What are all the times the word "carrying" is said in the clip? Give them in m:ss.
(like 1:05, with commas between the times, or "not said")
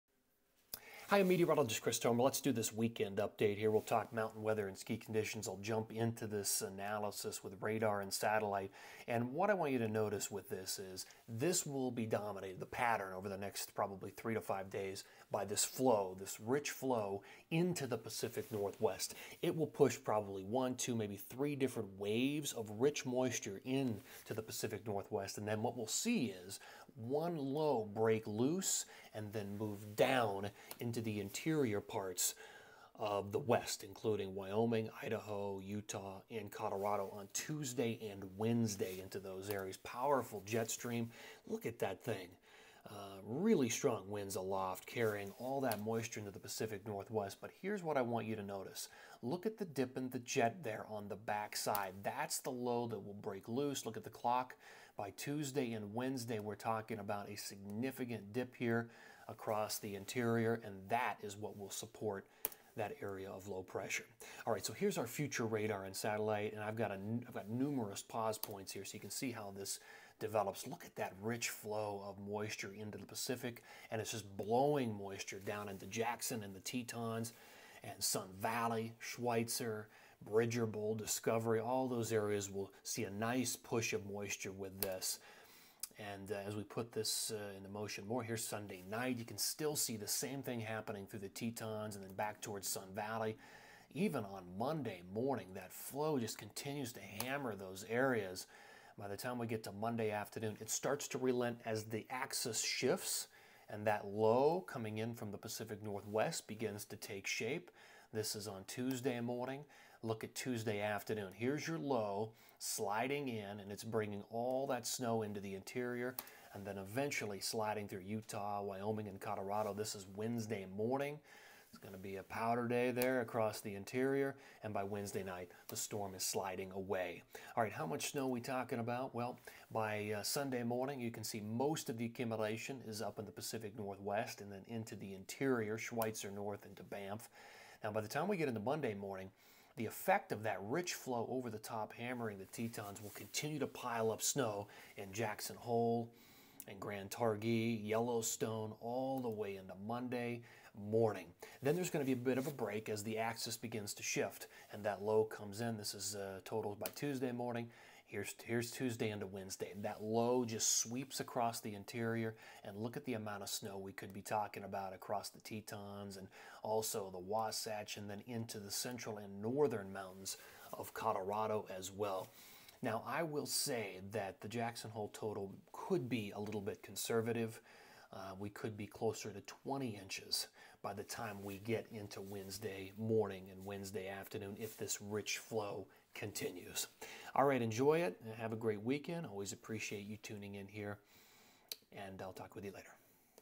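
0:44.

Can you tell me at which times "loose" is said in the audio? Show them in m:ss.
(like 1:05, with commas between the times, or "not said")
0:28, 0:53.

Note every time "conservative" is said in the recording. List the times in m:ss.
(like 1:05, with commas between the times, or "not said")
2:56.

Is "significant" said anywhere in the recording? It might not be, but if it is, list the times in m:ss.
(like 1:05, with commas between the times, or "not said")
0:57.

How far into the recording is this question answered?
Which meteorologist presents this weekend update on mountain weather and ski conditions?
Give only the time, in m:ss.
0:01.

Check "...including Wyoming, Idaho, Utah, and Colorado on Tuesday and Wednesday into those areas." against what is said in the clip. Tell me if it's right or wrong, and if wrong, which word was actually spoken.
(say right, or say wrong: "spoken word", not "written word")
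right.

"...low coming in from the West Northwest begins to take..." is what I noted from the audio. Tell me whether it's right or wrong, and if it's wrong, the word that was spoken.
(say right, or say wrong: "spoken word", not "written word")
wrong: "Pacific", not "West".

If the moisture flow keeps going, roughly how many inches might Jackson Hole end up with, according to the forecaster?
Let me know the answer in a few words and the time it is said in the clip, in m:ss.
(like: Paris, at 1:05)
20 inches, at 2:59.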